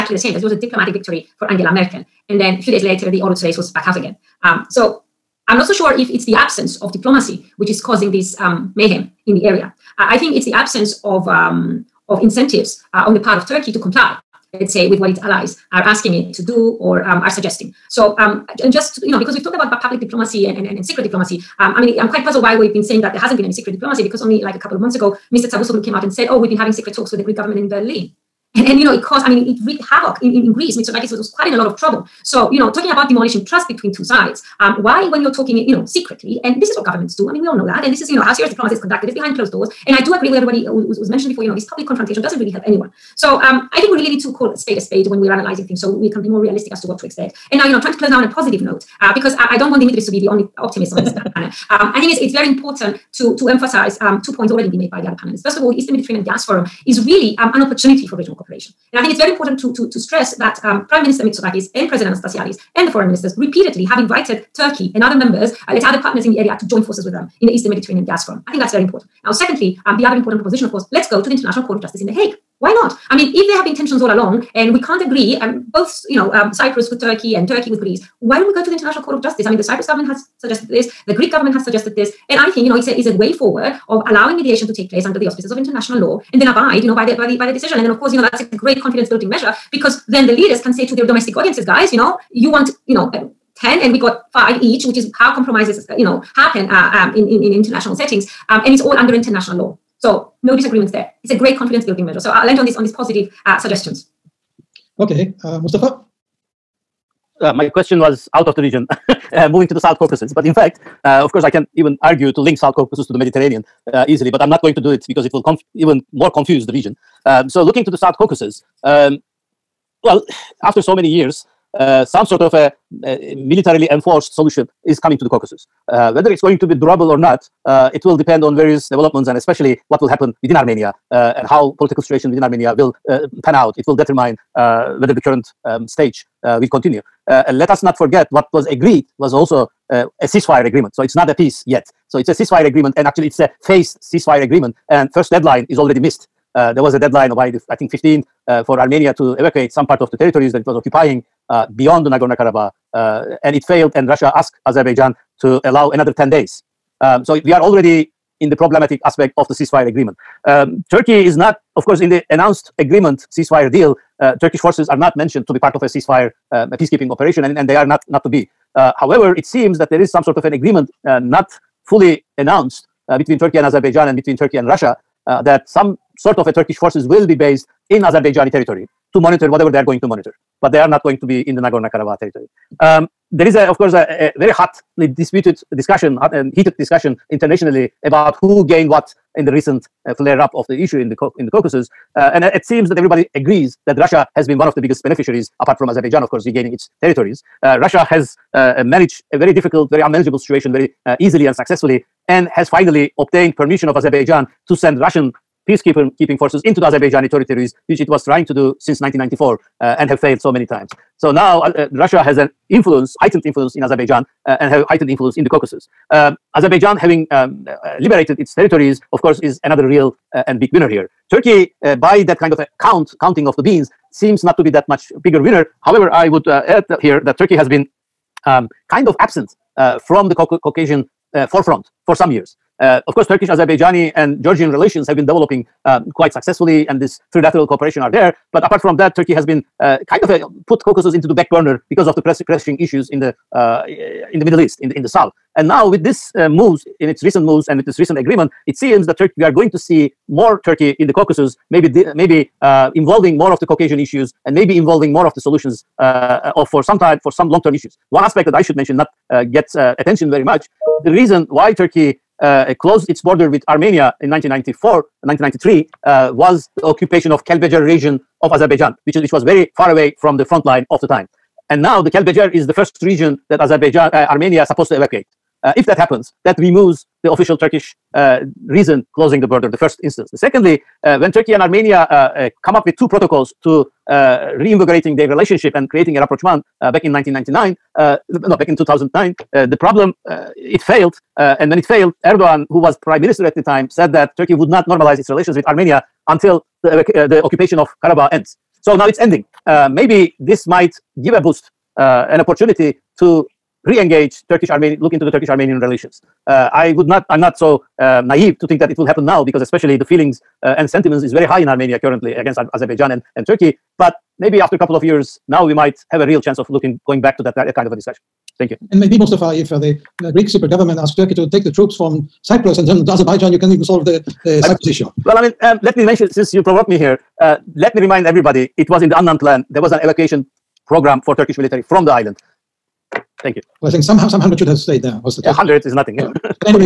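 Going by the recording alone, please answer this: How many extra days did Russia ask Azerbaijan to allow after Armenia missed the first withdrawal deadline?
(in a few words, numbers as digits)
10.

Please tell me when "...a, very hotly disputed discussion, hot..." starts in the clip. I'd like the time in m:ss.
3:04.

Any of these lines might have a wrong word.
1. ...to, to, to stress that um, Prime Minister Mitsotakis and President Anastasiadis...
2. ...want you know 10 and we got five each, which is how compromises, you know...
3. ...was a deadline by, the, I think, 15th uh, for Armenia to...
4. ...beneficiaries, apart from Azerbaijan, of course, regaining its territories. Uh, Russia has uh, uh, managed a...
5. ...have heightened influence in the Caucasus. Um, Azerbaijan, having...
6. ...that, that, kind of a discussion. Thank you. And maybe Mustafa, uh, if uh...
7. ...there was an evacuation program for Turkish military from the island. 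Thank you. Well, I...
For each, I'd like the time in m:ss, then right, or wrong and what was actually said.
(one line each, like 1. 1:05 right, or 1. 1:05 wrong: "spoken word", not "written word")
1. 0:59 right
2. 1:32 right
3. 2:26 right
4. 3:15 right
5. 3:34 right
6. 5:17 right
7. 5:29 right.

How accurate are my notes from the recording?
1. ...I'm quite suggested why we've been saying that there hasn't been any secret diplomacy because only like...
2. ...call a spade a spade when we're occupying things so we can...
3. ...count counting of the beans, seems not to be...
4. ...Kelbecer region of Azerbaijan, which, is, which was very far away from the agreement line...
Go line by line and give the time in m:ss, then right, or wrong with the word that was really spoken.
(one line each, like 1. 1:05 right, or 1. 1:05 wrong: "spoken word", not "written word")
1. 0:21 wrong: "puzzled", not "suggested"
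2. 0:44 wrong: "analyzing", not "occupying"
3. 3:42 right
4. 4:27 wrong: "front", not "agreement".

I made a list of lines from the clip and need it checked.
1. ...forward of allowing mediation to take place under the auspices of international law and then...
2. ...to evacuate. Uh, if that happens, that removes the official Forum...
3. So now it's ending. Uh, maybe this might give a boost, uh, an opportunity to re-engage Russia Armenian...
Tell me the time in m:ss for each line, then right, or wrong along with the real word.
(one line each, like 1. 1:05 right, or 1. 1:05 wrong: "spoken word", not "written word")
1. 1:23 right
2. 4:34 wrong: "Turkish", not "Forum"
3. 4:58 wrong: "Turkish", not "Russia".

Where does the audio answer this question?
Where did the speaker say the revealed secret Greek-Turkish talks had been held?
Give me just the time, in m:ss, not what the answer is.
0:27.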